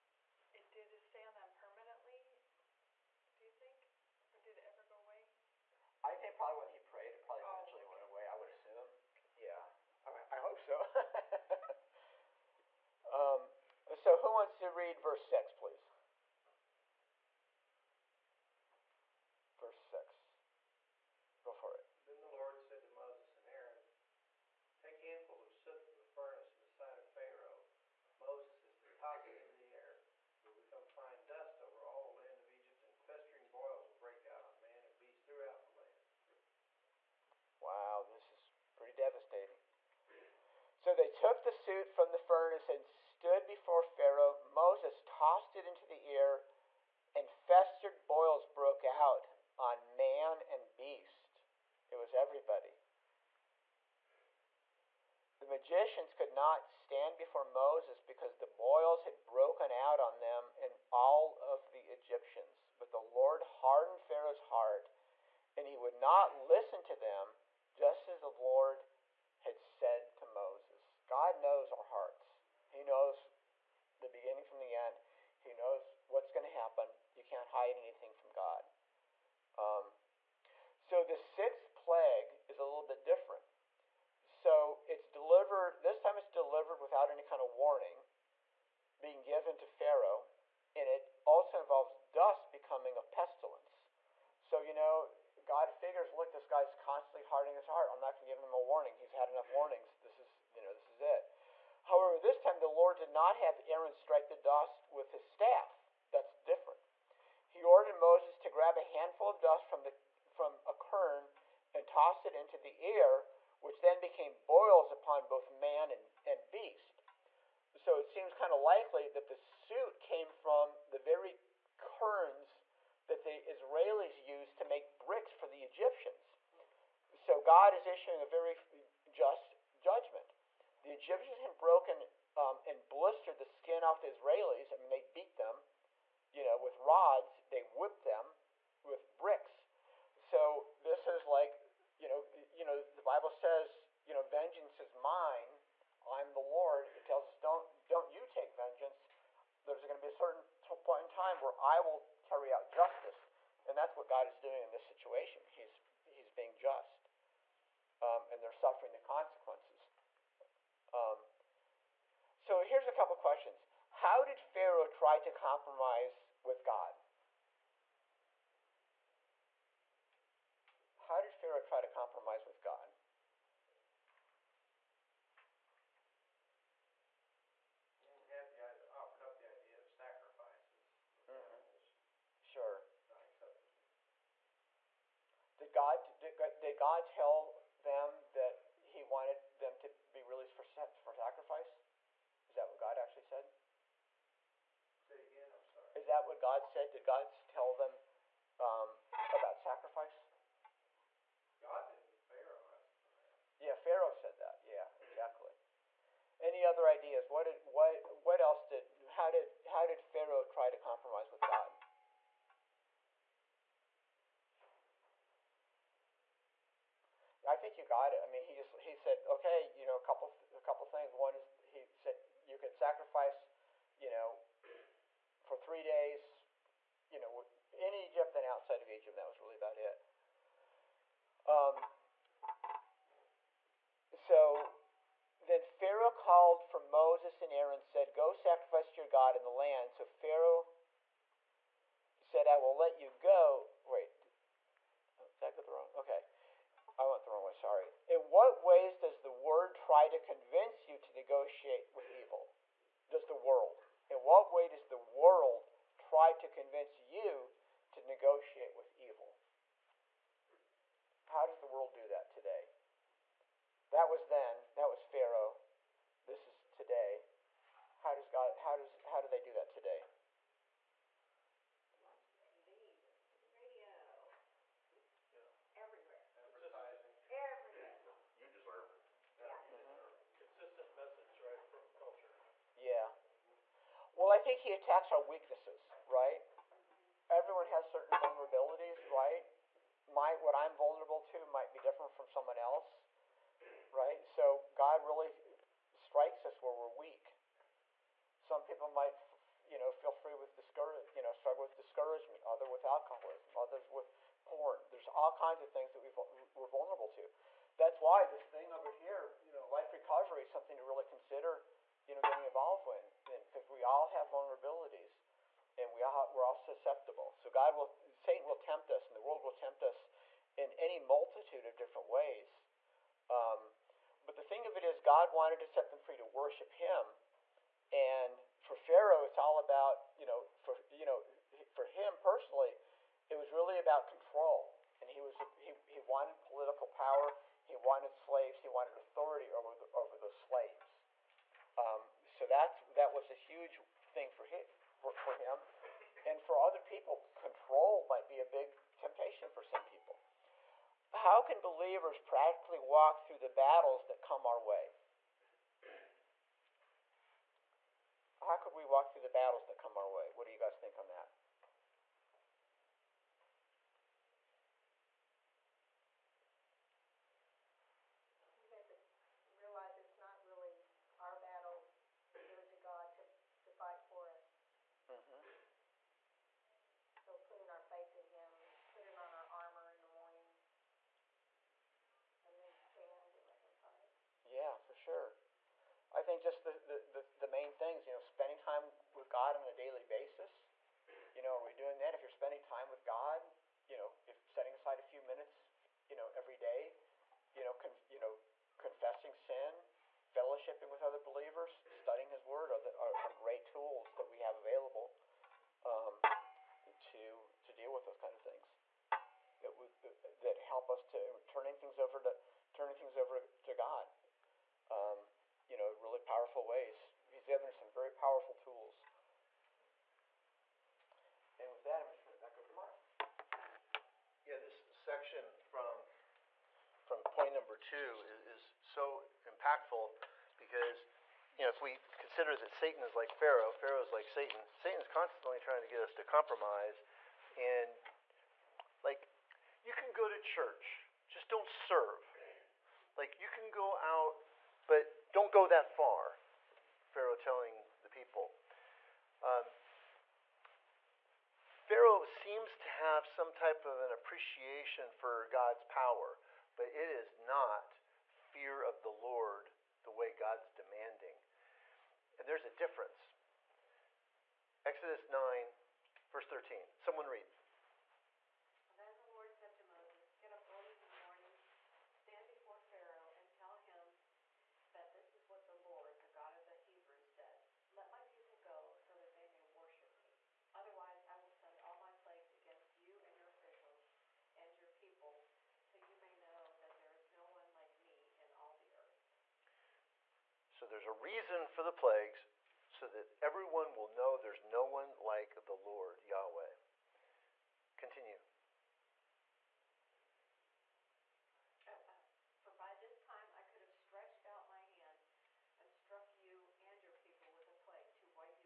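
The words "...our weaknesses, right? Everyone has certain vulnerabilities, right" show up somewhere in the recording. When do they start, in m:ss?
4:45.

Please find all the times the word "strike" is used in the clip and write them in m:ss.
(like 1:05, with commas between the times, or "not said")
1:43, 4:55.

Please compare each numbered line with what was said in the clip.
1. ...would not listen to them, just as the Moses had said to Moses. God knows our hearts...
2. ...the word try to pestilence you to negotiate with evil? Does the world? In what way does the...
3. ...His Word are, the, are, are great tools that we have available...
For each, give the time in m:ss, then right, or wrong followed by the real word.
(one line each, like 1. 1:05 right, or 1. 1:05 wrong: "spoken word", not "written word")
1. 1:05 wrong: "Lord", not "Moses"
2. 4:09 wrong: "convince", not "pestilence"
3. 6:42 right.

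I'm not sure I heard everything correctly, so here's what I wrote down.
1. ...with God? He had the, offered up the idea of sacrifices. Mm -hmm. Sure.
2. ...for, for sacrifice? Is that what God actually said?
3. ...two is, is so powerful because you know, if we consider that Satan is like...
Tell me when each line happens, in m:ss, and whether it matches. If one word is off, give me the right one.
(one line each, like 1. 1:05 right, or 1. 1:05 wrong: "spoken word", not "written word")
1. 2:52 right
2. 3:10 right
3. 7:07 wrong: "impactful", not "powerful".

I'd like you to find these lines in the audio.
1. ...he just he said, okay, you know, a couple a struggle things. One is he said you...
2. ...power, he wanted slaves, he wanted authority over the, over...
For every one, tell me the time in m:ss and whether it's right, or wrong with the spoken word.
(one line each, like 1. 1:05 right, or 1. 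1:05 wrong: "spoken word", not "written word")
1. 3:38 wrong: "couple", not "struggle"
2. 5:36 right.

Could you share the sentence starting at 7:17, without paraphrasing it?
And, like, you can go to church, just don't serve.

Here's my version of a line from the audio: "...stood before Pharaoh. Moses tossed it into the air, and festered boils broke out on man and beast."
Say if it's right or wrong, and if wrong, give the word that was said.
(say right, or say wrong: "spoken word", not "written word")
right.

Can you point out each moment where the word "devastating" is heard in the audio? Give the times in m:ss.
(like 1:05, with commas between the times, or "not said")
0:38.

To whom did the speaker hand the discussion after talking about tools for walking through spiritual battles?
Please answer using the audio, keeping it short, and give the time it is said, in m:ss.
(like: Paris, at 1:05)
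Mark, at 7:02.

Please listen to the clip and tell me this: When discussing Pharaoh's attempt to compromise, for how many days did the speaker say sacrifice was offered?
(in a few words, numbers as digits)
3.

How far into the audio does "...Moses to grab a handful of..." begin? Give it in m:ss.
1:47.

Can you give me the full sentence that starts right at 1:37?
I'm not going to give him a warning.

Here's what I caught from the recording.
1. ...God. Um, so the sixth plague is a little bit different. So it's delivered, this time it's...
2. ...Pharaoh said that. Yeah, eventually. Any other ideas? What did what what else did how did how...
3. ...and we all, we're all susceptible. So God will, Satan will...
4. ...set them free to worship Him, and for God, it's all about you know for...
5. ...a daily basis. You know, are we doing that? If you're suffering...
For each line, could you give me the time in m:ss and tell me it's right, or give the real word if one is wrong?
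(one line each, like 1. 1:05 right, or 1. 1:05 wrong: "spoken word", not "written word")
1. 1:18 right
2. 3:23 wrong: "exactly", not "eventually"
3. 5:15 right
4. 5:25 wrong: "Pharaoh", not "God"
5. 6:29 wrong: "spending", not "suffering".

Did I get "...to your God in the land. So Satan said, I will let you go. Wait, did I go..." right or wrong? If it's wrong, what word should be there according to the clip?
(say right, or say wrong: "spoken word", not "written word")
wrong: "Pharaoh", not "Satan".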